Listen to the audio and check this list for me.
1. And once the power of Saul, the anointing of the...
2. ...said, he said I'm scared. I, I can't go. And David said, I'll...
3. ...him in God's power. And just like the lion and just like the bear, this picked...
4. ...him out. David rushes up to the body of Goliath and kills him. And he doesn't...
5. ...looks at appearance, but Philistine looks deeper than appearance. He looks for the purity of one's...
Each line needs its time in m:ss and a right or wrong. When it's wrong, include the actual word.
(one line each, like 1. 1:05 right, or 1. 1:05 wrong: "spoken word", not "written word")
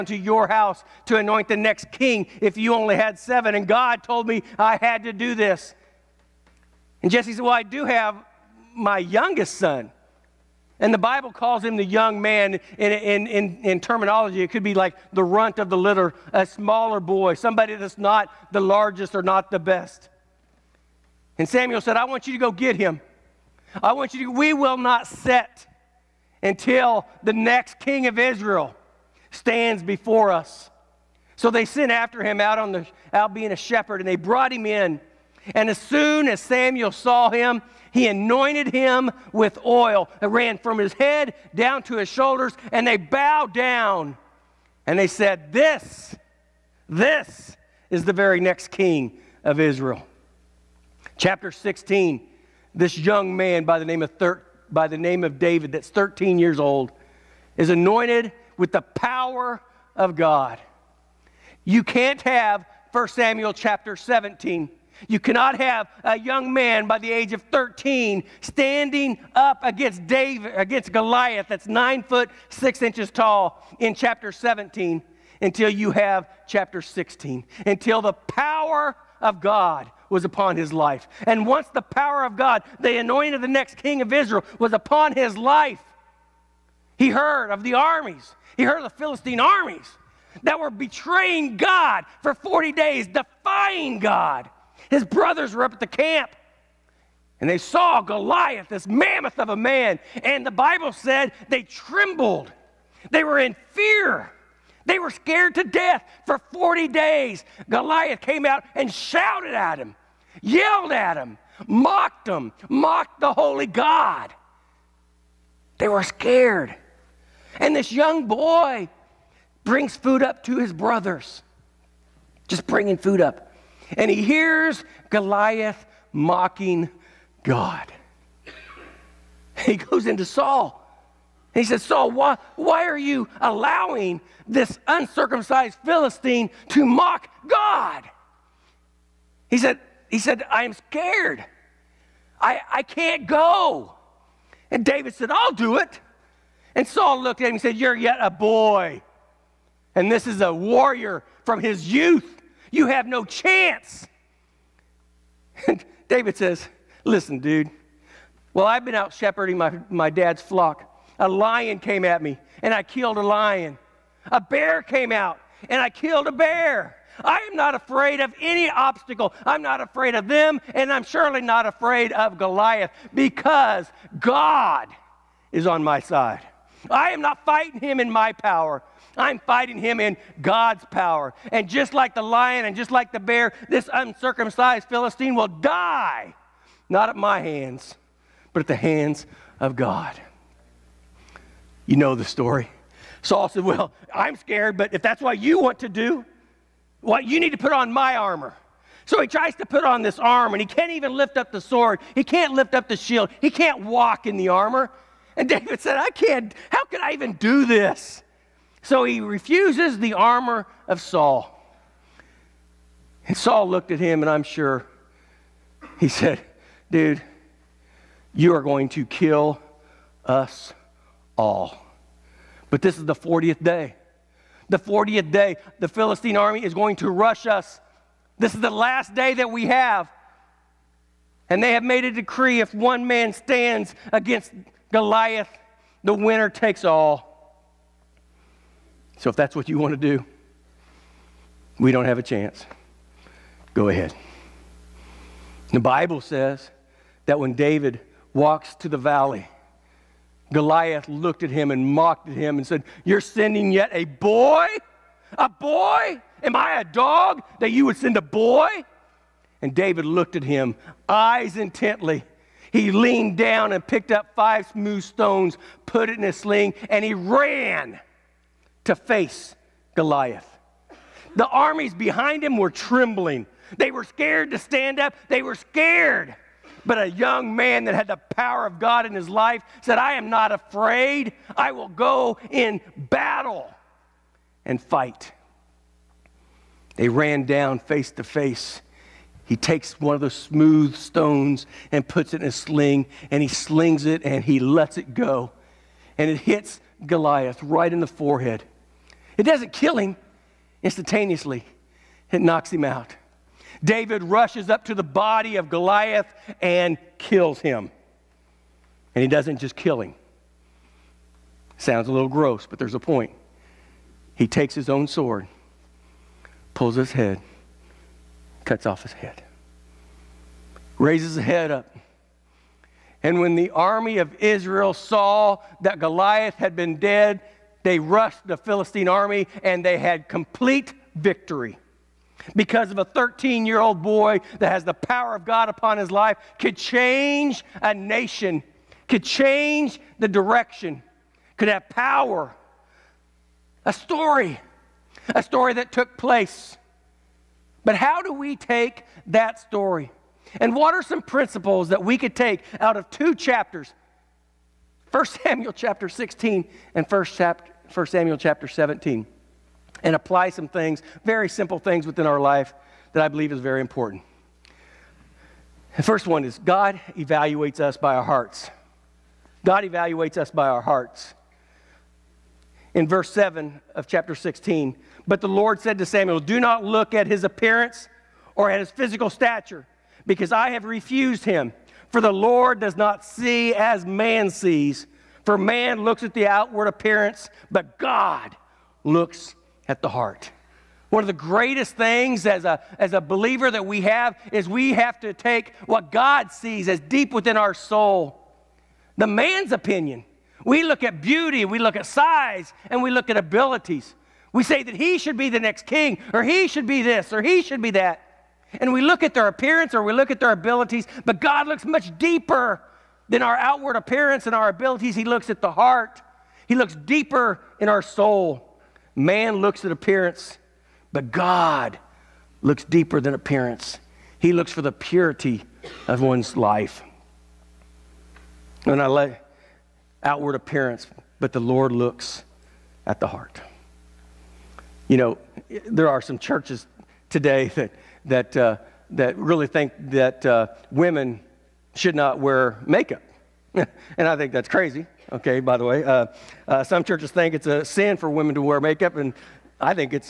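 1. 1:21 wrong: "God", not "Saul"
2. 2:19 right
3. 2:59 wrong: "uncircumcised", not "picked"
4. 5:02 right
5. 6:59 wrong: "God", not "Philistine".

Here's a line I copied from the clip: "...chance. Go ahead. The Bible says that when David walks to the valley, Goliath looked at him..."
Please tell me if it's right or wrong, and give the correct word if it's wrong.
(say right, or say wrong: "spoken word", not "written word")
right.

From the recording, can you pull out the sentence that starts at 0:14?
It could be like the runt of the litter, a smaller boy, somebody that's not the largest or not the best.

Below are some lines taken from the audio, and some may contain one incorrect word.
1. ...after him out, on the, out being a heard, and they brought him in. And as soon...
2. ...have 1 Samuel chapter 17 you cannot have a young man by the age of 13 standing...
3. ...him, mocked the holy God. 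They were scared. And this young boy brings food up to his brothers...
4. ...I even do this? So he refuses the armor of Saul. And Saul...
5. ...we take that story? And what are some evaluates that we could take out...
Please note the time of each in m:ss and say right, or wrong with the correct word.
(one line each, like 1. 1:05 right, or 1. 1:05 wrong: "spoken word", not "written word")
1. 0:31 wrong: "shepherd", not "heard"
2. 1:02 right
3. 1:52 right
4. 3:27 right
5. 5:48 wrong: "principles", not "evaluates".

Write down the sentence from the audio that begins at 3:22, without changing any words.
He can't lift up the shield.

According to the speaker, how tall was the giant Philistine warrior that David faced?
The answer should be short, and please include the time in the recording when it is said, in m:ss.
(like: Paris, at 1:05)
9 foot 6 inches, at 1:11.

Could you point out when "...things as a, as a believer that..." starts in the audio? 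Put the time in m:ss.
6:31.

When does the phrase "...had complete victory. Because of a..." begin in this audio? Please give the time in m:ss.
5:29.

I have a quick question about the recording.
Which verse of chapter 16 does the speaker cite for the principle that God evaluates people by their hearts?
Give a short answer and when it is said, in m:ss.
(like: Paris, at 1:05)
Verse 7, at 6:13.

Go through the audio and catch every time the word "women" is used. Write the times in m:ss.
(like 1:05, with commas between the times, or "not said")
7:20, 7:28.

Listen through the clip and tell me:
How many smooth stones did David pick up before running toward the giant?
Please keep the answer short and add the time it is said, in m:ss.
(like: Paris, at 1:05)
5, at 4:24.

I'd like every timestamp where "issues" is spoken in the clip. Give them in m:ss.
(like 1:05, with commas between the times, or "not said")
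not said.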